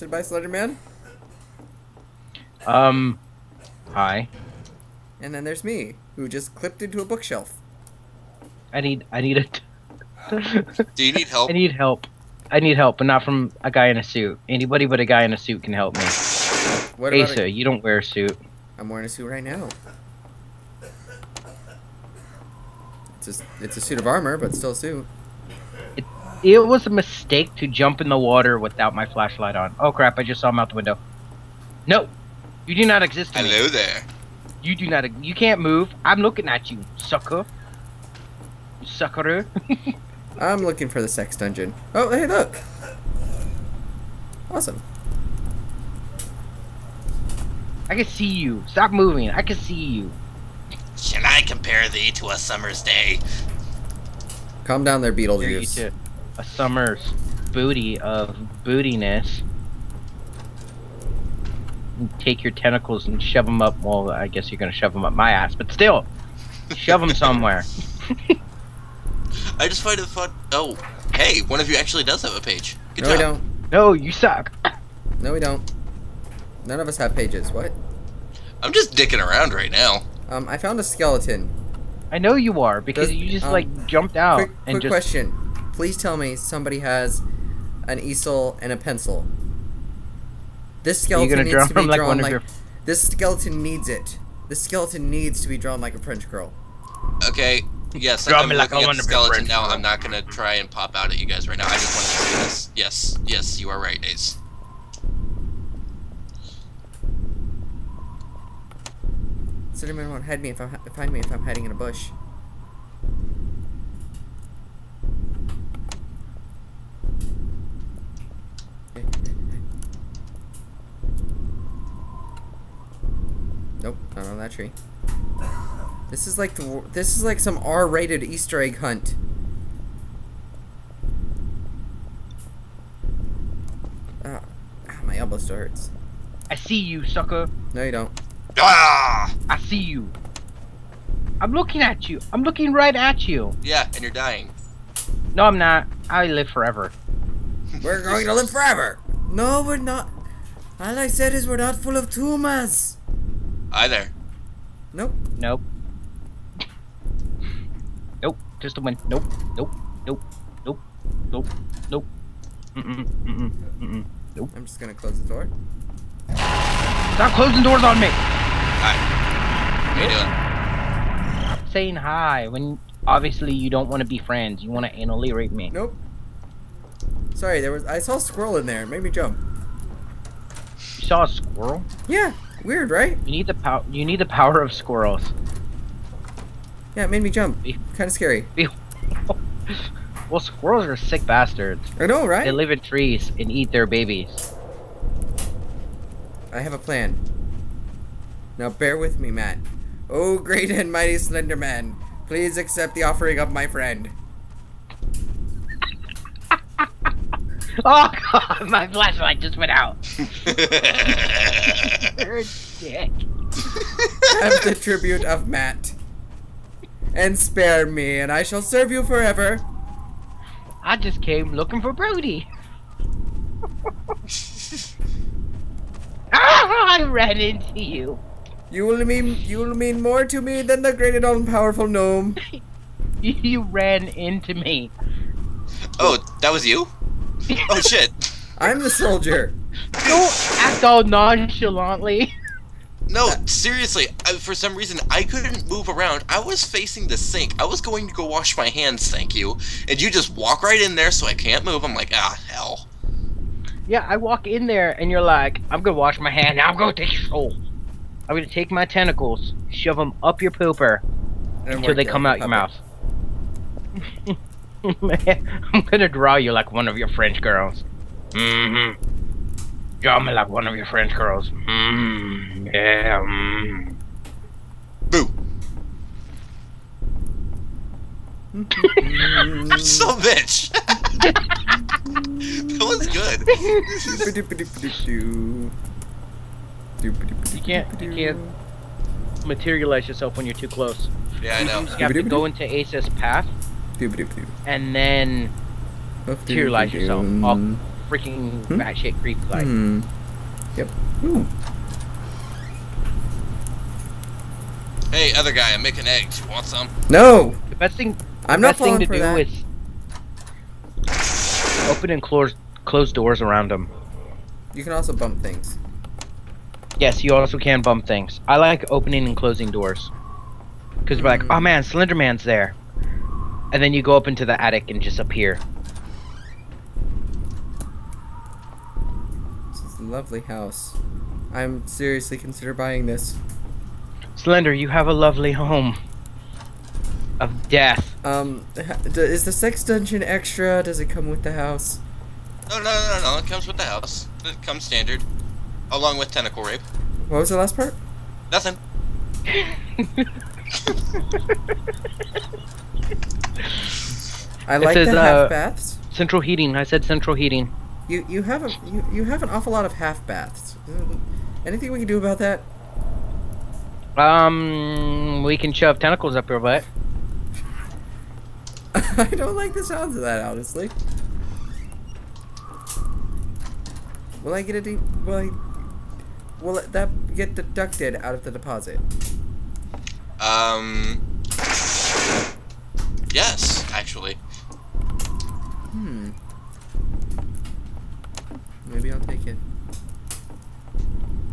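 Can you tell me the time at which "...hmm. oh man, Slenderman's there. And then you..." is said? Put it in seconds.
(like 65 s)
321 s.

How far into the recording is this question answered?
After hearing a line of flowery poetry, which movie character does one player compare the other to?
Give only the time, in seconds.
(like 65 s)
55 s.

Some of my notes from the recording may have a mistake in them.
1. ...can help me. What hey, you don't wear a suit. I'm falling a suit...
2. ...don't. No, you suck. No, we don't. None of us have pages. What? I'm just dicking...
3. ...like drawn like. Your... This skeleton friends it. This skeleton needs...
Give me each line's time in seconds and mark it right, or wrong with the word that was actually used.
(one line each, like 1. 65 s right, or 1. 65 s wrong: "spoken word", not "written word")
1. 15 s wrong: "wearing", not "falling"
2. 73 s right
3. 91 s wrong: "needs", not "friends".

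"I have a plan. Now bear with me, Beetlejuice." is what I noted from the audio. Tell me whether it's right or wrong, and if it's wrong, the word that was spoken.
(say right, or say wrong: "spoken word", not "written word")
wrong: "Matt", not "Beetlejuice".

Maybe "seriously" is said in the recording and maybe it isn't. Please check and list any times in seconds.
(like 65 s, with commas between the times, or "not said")
243 s, 331 s.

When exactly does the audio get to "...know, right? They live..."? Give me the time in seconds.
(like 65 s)
192 s.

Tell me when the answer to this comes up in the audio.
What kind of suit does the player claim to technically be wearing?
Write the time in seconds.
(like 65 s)
23 s.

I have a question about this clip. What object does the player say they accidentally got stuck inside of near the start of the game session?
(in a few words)
A bookshelf.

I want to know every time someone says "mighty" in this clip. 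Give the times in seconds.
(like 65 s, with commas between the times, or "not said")
200 s.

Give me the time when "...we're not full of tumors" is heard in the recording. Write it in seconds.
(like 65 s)
151 s.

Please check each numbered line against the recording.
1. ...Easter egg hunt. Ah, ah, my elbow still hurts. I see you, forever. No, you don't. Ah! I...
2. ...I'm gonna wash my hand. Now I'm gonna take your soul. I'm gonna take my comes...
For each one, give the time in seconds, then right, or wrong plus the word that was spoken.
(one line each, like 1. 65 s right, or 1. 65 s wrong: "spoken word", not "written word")
1. 128 s wrong: "sucker", not "forever"
2. 255 s wrong: "tentacles", not "comes".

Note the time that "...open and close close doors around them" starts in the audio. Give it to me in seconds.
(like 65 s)
311 s.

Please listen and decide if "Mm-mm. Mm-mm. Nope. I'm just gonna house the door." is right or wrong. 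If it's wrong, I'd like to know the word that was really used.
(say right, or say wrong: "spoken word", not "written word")
wrong: "close", not "house".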